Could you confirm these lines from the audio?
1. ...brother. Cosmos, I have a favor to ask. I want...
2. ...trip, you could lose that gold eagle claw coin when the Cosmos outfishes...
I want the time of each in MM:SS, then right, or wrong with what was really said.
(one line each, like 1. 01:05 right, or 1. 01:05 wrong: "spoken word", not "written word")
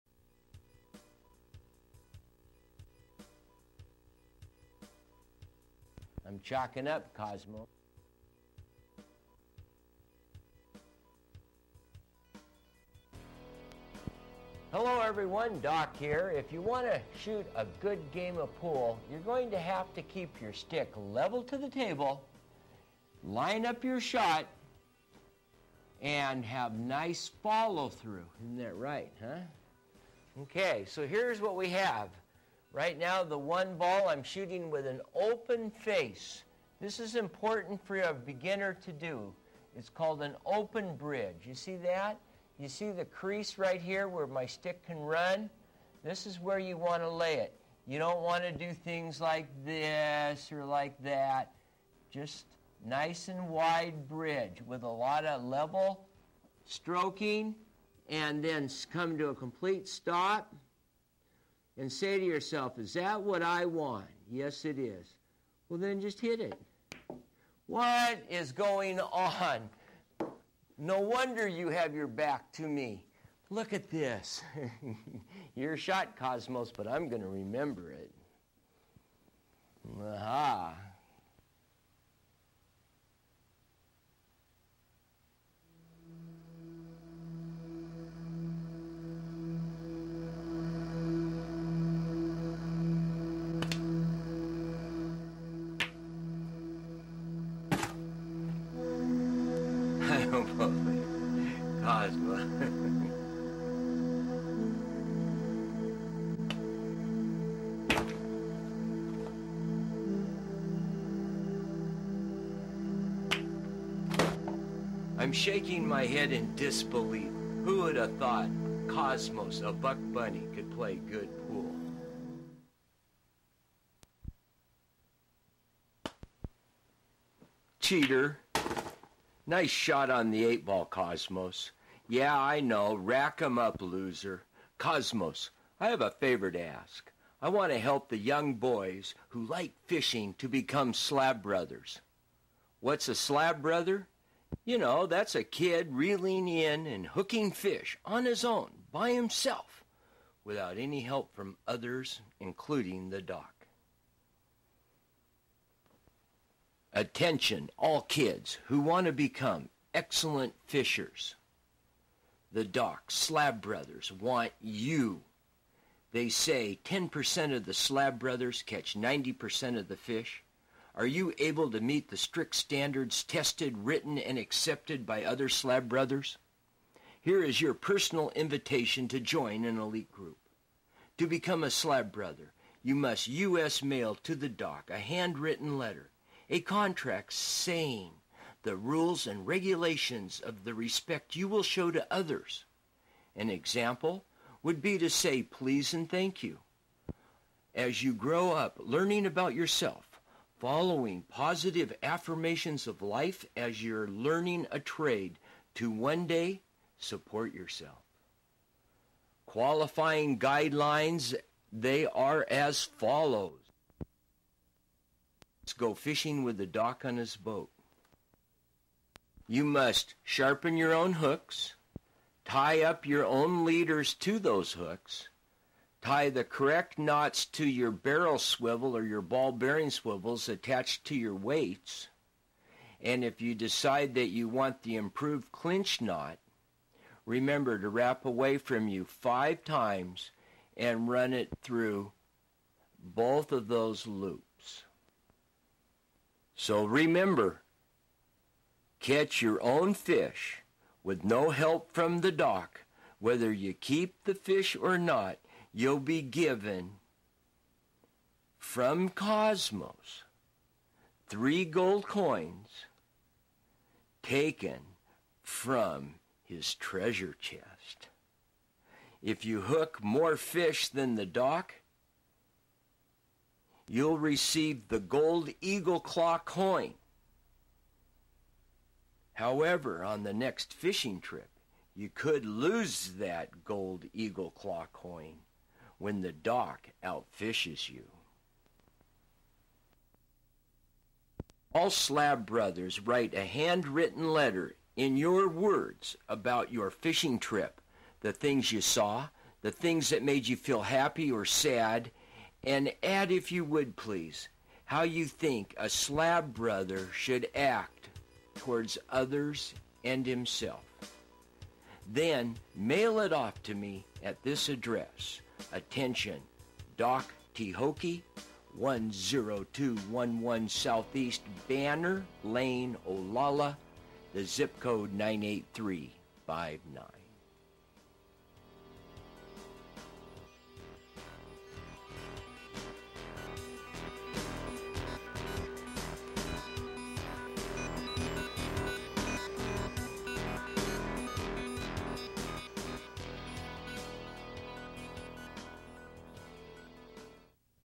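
1. 02:13 wrong: "loser", not "brother"
2. 04:41 wrong: "Doc", not "Cosmos".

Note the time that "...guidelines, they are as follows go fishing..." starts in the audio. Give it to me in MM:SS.
03:30.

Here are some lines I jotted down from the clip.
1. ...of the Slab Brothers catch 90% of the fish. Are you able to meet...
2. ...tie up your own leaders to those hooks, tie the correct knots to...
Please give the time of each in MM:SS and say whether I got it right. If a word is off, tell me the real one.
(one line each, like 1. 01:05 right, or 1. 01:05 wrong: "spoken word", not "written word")
1. 02:47 right
2. 03:42 right.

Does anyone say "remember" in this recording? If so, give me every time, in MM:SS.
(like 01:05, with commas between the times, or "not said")
01:17, 03:57, 04:06.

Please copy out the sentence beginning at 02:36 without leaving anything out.
Attention, all kids who want to become excellent fishers.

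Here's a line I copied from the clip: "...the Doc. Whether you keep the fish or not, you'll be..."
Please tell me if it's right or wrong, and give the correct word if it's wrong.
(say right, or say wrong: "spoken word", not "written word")
right.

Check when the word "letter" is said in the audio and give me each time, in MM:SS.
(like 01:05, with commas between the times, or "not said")
03:05, 04:54.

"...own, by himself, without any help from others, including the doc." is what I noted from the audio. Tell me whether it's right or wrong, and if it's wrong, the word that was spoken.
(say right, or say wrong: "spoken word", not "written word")
right.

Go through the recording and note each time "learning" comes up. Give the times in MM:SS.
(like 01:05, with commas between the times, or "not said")
03:18, 03:24.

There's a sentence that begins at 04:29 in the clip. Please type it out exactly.
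If you hook more fish than the Doc, you'll receive the gold eagle claw coin.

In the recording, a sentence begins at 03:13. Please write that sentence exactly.
An example would be to say please and thank you.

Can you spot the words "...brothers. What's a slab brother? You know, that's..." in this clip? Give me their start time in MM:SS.
02:21.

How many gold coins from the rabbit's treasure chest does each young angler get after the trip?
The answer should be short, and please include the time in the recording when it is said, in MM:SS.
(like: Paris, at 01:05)
3, at 04:21.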